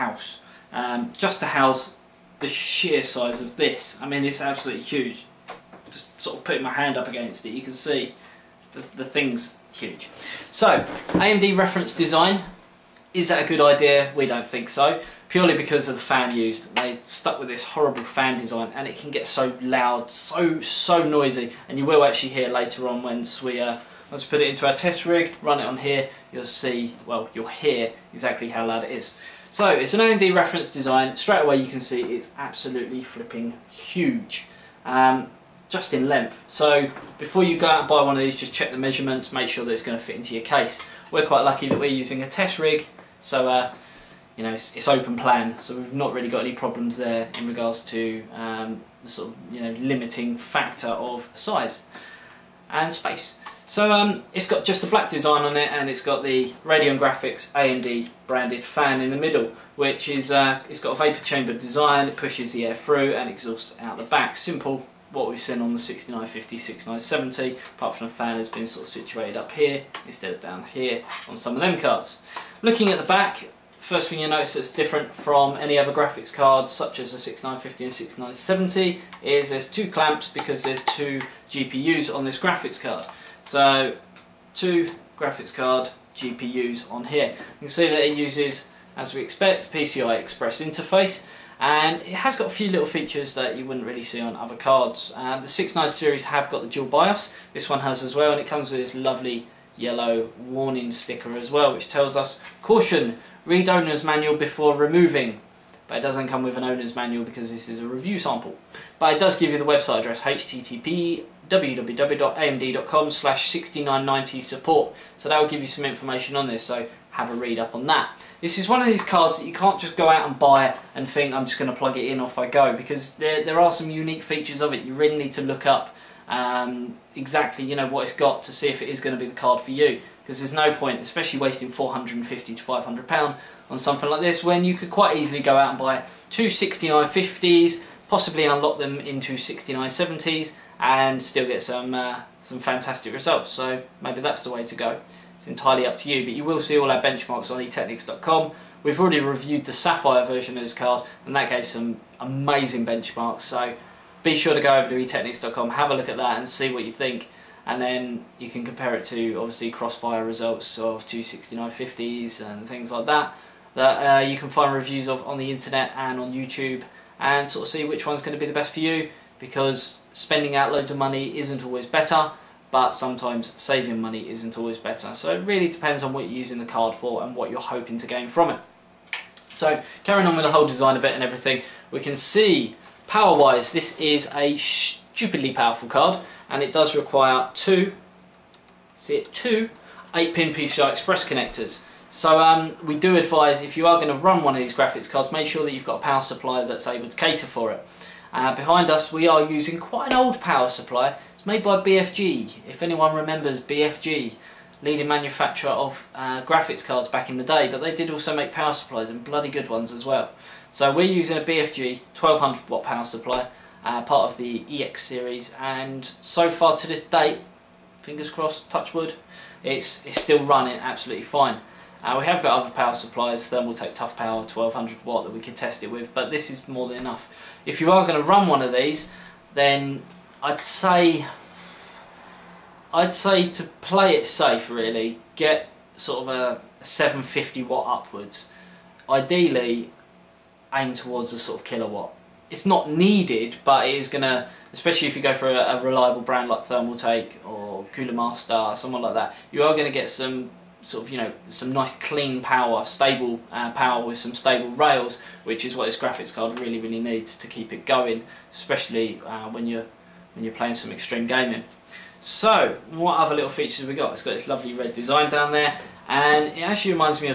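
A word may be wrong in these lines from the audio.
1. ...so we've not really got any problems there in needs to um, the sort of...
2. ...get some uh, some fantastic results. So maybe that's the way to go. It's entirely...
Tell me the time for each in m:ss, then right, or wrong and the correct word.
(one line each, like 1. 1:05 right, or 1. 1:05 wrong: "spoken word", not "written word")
1. 0:45 wrong: "regards", not "needs"
2. 2:21 right.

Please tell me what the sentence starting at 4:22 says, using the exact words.
So, what other little features have we got?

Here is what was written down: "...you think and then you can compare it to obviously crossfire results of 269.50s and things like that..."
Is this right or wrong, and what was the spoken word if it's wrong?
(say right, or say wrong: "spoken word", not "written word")
right.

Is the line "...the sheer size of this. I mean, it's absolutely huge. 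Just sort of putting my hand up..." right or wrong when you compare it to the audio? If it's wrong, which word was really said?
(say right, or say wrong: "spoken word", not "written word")
right.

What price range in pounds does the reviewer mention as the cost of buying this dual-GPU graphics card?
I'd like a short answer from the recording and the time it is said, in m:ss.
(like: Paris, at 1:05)
450 to 500 pounds, at 2:11.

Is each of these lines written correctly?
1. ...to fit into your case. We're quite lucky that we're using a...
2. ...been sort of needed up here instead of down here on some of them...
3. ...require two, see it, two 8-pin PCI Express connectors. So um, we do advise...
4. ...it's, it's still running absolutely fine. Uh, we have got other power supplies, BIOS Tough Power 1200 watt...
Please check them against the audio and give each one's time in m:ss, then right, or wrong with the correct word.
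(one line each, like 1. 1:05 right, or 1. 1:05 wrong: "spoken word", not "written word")
1. 0:39 right
2. 1:08 wrong: "situated", not "needed"
3. 3:06 right
4. 3:39 wrong: "Thermaltake", not "BIOS".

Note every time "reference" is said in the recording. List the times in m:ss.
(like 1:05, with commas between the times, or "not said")
0:11, 0:30.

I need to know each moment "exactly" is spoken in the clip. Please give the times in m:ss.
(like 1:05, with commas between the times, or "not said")
0:28, 2:07.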